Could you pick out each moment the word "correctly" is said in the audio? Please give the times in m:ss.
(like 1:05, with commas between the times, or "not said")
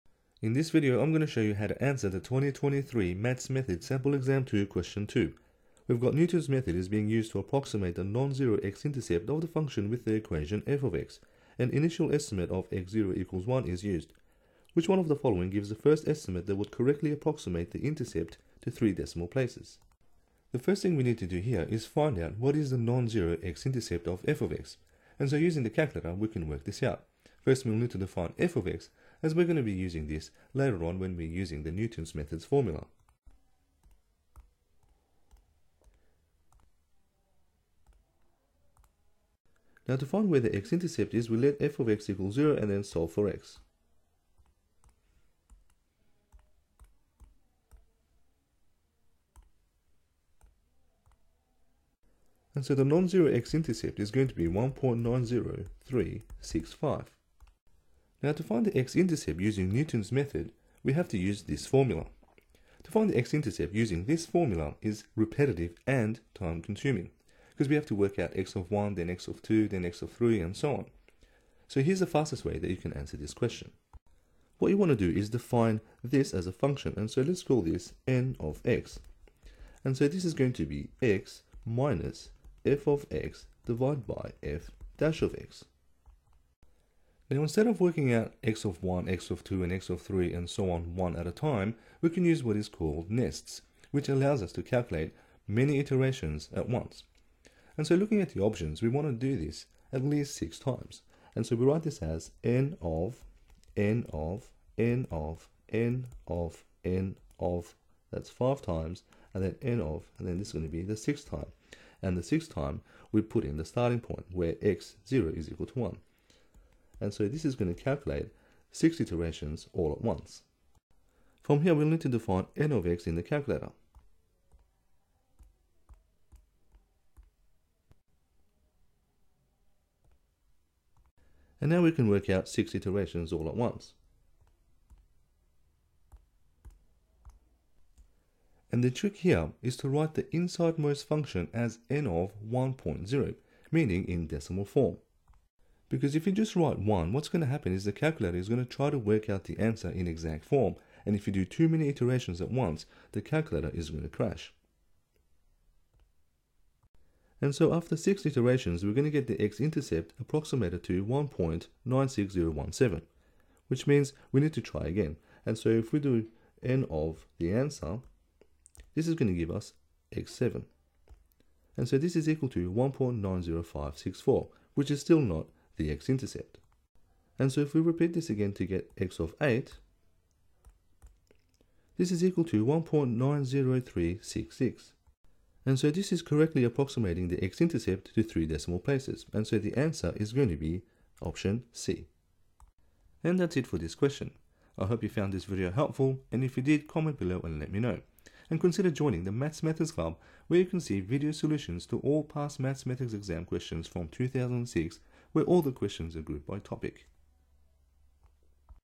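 0:16, 3:06.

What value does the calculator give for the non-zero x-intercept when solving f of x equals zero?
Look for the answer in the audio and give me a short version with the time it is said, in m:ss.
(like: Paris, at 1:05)
1.90365, at 0:54.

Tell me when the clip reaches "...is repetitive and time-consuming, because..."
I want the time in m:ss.
1:04.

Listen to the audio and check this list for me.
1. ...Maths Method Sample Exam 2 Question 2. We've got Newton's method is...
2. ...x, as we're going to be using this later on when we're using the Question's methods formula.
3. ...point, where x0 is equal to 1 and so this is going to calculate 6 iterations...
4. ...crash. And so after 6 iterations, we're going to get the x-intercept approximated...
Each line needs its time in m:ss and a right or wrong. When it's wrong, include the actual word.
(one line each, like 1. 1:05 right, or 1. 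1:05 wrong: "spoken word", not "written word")
1. 0:03 right
2. 0:28 wrong: "Newton", not "Question"
3. 1:54 right
4. 2:34 right.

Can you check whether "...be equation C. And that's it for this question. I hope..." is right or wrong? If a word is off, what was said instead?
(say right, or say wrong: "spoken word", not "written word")
wrong: "option", not "equation".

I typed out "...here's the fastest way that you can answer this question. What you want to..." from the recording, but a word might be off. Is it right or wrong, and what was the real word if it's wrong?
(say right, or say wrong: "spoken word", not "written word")
right.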